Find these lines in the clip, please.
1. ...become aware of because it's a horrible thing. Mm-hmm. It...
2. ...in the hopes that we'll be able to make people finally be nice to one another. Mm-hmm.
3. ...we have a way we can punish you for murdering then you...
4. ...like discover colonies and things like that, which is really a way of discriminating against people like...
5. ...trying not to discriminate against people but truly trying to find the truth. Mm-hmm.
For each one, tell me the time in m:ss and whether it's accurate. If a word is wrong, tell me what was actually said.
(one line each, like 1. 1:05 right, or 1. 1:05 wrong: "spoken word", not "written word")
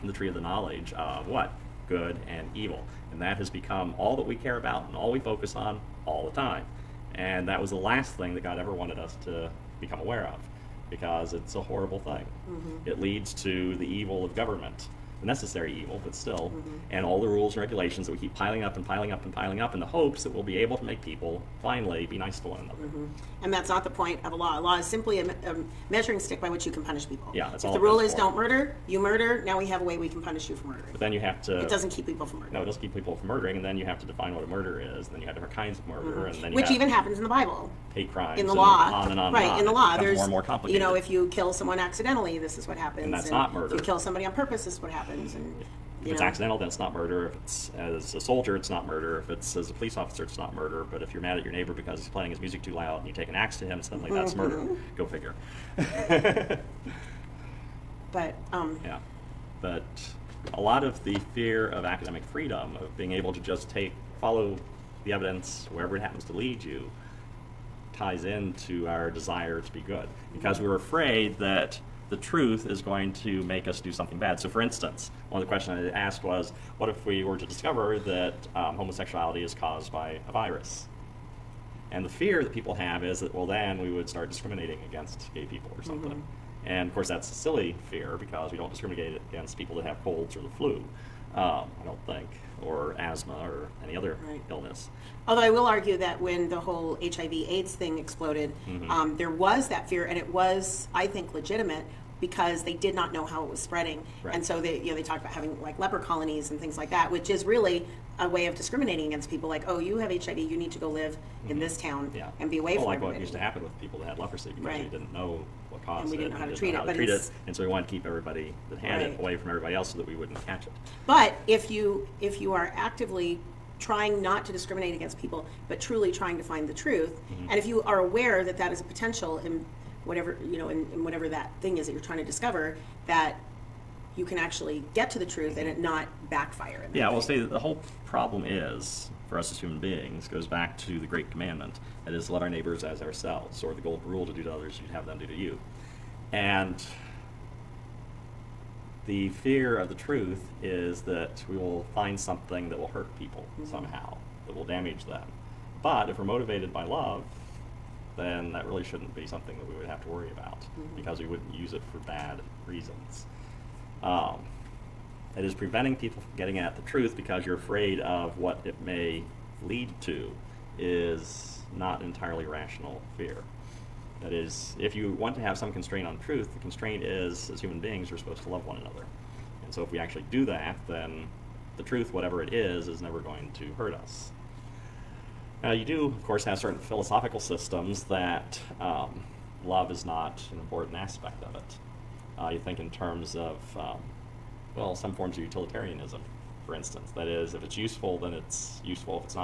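1. 0:09 right
2. 0:19 right
3. 0:29 right
4. 1:45 wrong: "leper", not "discover"
5. 2:03 right.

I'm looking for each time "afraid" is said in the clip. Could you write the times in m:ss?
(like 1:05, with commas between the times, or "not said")
1:10, 2:47.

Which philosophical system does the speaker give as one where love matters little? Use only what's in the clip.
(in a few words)
Utilitarianism.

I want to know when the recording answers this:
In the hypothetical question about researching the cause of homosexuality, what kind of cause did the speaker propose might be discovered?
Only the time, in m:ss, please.
1:20.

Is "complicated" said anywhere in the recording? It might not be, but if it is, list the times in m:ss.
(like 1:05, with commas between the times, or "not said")
0:40.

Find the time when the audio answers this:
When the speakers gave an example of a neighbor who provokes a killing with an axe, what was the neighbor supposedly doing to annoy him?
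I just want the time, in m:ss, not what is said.
0:52.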